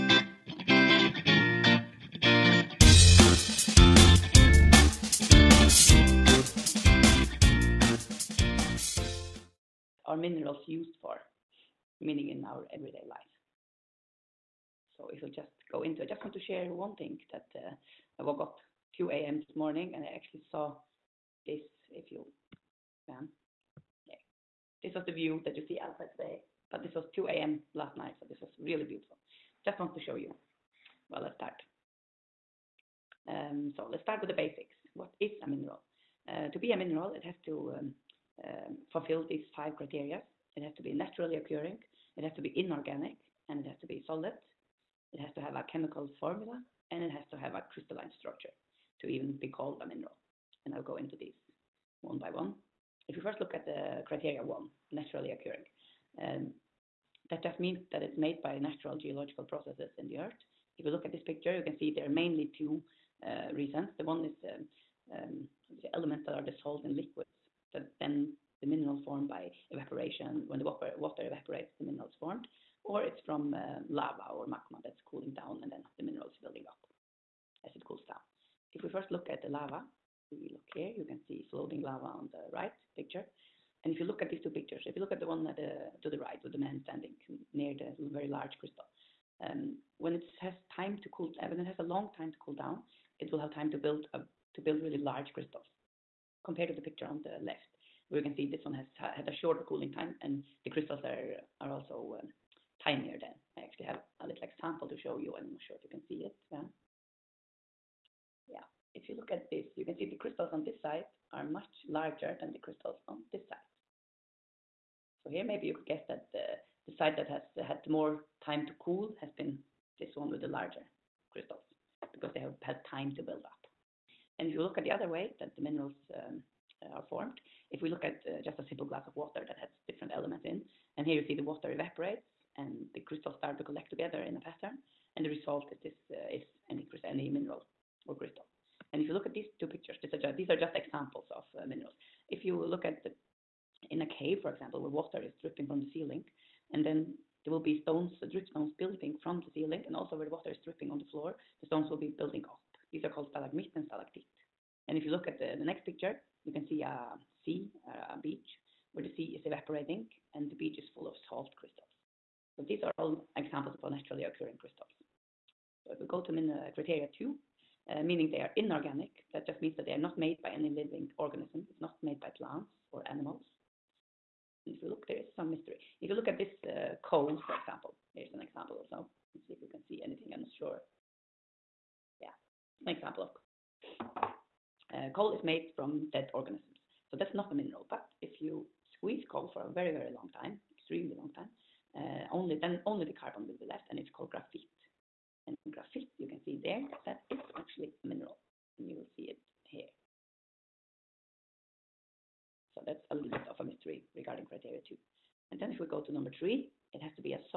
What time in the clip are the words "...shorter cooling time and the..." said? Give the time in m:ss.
1:39.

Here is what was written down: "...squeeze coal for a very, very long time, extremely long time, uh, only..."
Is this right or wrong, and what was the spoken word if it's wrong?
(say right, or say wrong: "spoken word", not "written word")
right.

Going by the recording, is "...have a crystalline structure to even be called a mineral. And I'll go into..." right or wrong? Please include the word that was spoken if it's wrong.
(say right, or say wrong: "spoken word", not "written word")
right.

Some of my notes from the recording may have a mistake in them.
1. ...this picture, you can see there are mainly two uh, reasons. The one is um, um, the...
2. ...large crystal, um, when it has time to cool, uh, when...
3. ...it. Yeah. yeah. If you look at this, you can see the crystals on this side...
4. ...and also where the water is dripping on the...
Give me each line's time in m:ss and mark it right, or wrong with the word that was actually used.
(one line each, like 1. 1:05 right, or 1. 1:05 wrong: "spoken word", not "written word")
1. 1:01 right
2. 1:28 right
3. 1:46 right
4. 2:29 right.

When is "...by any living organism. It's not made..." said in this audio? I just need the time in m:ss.
2:50.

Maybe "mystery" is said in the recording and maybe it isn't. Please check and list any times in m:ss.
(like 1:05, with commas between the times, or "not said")
2:55, 3:23.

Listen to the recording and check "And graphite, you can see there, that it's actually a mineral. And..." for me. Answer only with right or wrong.
right.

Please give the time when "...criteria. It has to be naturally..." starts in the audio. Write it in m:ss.
0:39.